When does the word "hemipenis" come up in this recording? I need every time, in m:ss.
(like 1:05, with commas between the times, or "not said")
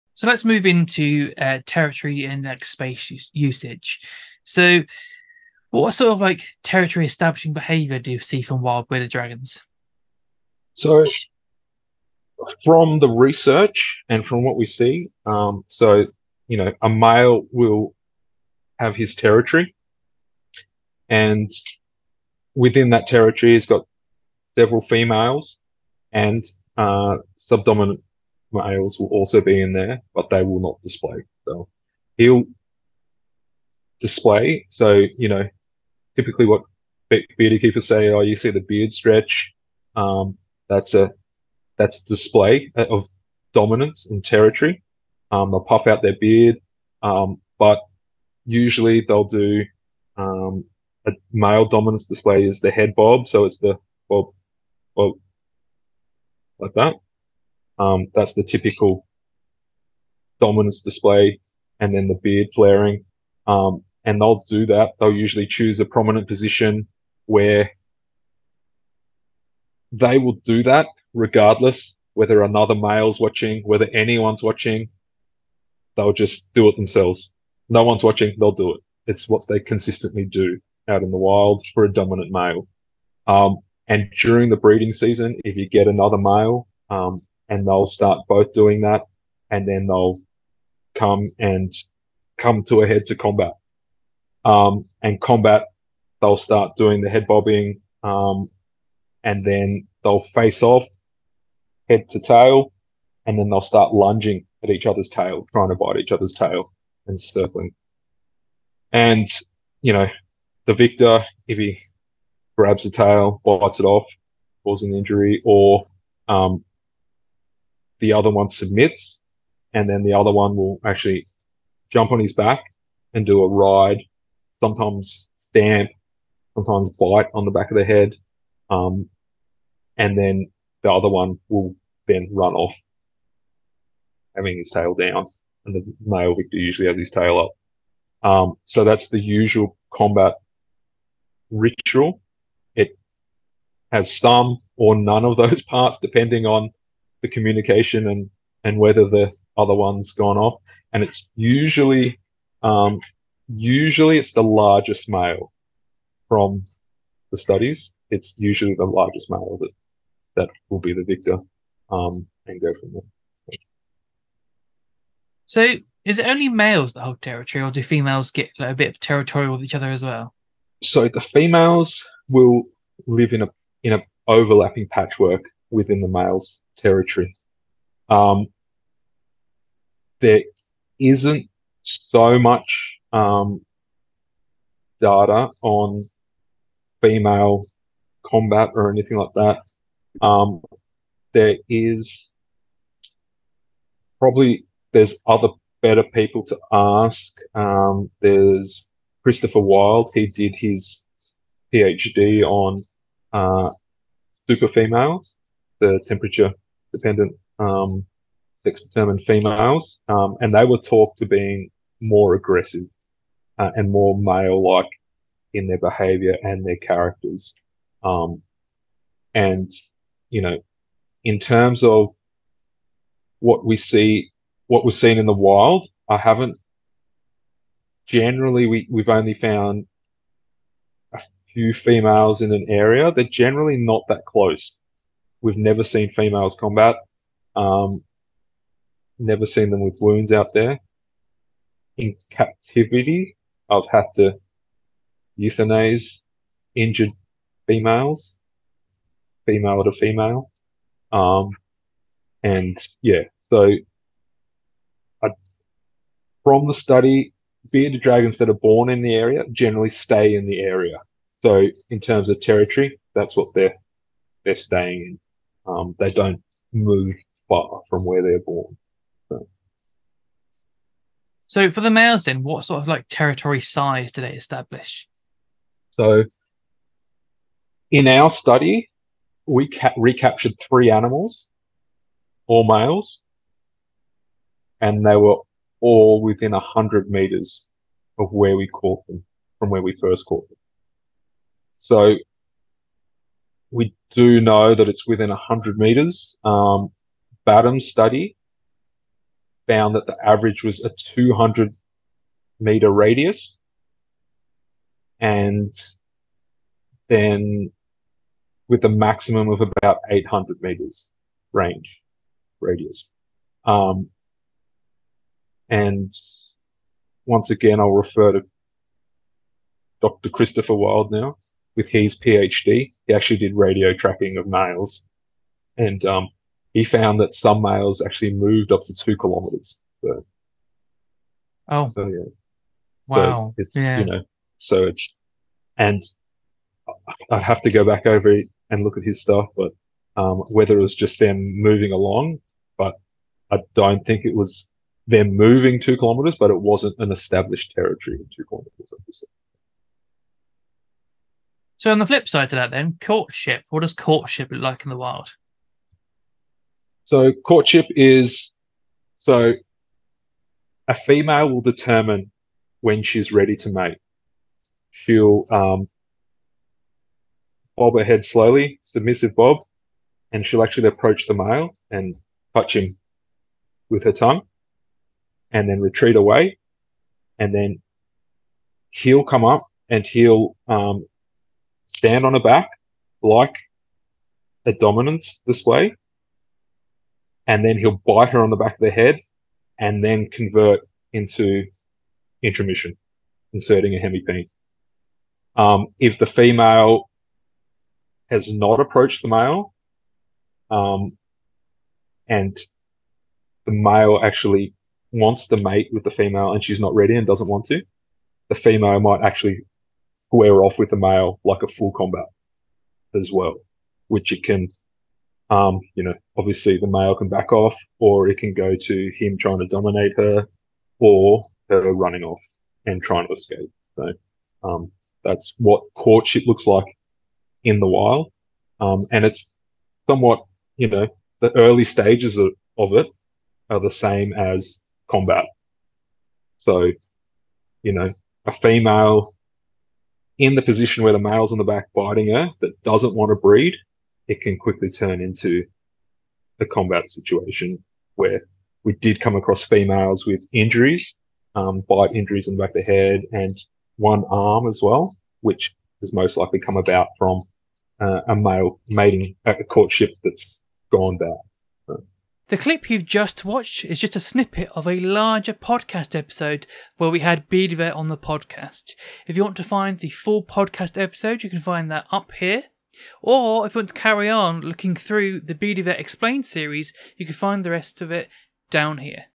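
6:33.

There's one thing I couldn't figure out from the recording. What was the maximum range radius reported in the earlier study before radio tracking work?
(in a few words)
800 meters.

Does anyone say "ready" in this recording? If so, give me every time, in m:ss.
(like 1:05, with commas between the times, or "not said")
6:03, 6:46.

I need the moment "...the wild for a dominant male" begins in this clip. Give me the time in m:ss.
1:21.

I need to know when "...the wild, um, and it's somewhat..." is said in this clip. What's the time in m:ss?
7:07.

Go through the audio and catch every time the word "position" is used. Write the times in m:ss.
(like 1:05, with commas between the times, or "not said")
1:06, 7:20.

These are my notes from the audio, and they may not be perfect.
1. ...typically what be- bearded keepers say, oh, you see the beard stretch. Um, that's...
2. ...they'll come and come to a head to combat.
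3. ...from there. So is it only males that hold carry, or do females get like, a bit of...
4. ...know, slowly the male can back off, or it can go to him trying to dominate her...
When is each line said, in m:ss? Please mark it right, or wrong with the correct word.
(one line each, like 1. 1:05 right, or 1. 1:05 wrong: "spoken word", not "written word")
1. 0:36 right
2. 1:29 right
3. 2:42 wrong: "territory", not "carry"
4. 6:56 wrong: "obviously", not "slowly".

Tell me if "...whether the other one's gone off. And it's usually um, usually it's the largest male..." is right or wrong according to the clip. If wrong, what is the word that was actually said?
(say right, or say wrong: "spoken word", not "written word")
right.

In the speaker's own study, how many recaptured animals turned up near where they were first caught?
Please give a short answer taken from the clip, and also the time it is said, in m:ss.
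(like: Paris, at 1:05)
3, at 4:40.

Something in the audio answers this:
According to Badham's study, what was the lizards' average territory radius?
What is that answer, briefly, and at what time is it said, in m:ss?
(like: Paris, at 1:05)
200 meters, at 5:00.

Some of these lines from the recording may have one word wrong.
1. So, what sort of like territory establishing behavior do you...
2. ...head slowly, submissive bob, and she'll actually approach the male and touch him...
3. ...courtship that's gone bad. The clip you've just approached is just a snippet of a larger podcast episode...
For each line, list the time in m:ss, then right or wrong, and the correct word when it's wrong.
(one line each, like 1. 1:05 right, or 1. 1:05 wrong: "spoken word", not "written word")
1. 0:04 right
2. 6:08 right
3. 7:39 wrong: "watched", not "approached".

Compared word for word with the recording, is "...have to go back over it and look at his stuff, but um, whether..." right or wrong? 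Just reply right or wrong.
right.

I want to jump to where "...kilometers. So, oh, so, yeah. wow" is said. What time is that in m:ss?
5:29.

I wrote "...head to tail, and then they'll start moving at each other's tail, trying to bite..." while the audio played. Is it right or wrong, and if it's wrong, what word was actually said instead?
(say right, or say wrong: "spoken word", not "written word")
wrong: "lunging", not "moving".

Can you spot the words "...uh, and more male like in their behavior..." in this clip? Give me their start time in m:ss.
3:33.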